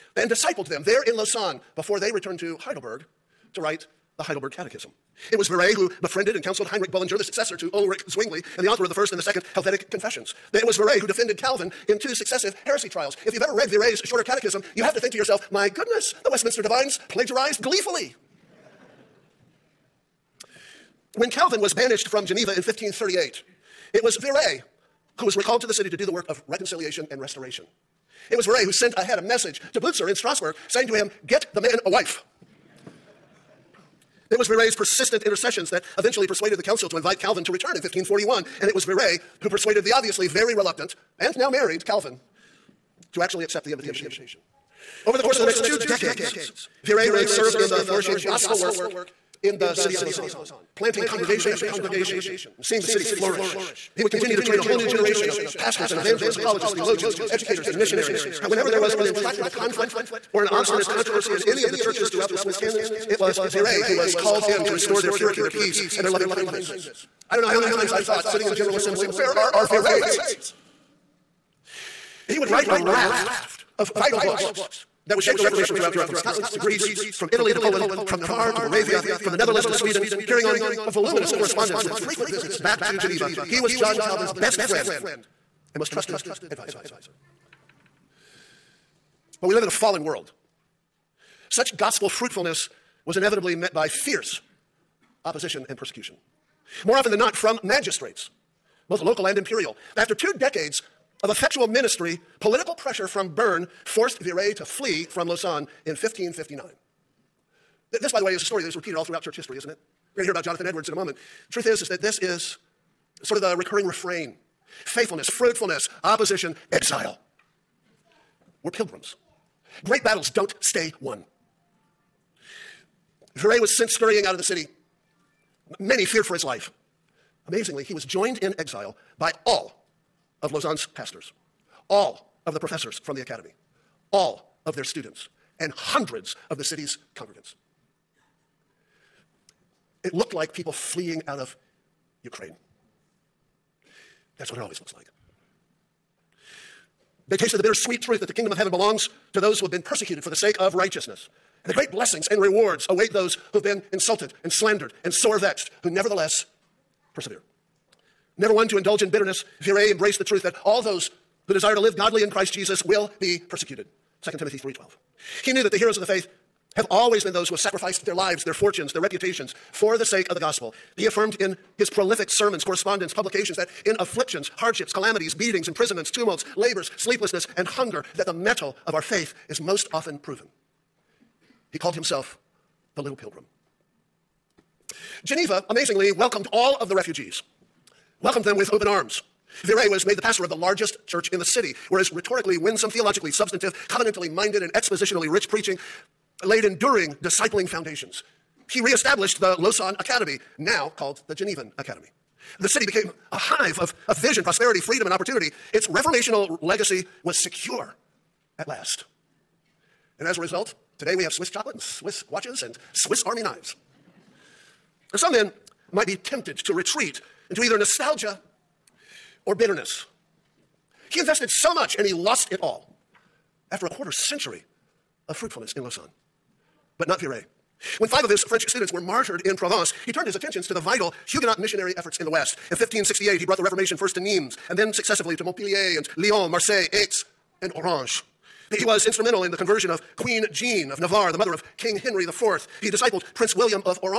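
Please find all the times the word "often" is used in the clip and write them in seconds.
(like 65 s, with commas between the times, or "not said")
96 s, 179 s.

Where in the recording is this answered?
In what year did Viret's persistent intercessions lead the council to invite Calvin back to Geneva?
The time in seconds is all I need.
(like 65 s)
37 s.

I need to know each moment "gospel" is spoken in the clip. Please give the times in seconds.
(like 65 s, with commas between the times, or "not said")
48 s, 91 s, 170 s.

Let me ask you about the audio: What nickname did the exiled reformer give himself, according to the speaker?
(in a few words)
the little pilgrim.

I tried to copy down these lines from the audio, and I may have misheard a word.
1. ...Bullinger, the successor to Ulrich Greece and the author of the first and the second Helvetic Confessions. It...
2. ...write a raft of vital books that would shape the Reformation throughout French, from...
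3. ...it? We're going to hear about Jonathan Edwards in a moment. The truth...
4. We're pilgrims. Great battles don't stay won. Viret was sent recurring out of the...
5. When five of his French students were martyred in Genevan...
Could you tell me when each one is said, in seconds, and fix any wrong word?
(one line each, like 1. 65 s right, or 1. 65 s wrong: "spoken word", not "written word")
1. 6 s wrong: "Zwingli", not "Greece"
2. 72 s wrong: "Europe", not "French"
3. 109 s right
4. 118 s wrong: "scurrying", not "recurring"
5. 227 s wrong: "Provence", not "Genevan".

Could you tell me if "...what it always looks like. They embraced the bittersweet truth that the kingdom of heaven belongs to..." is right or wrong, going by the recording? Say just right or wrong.
wrong.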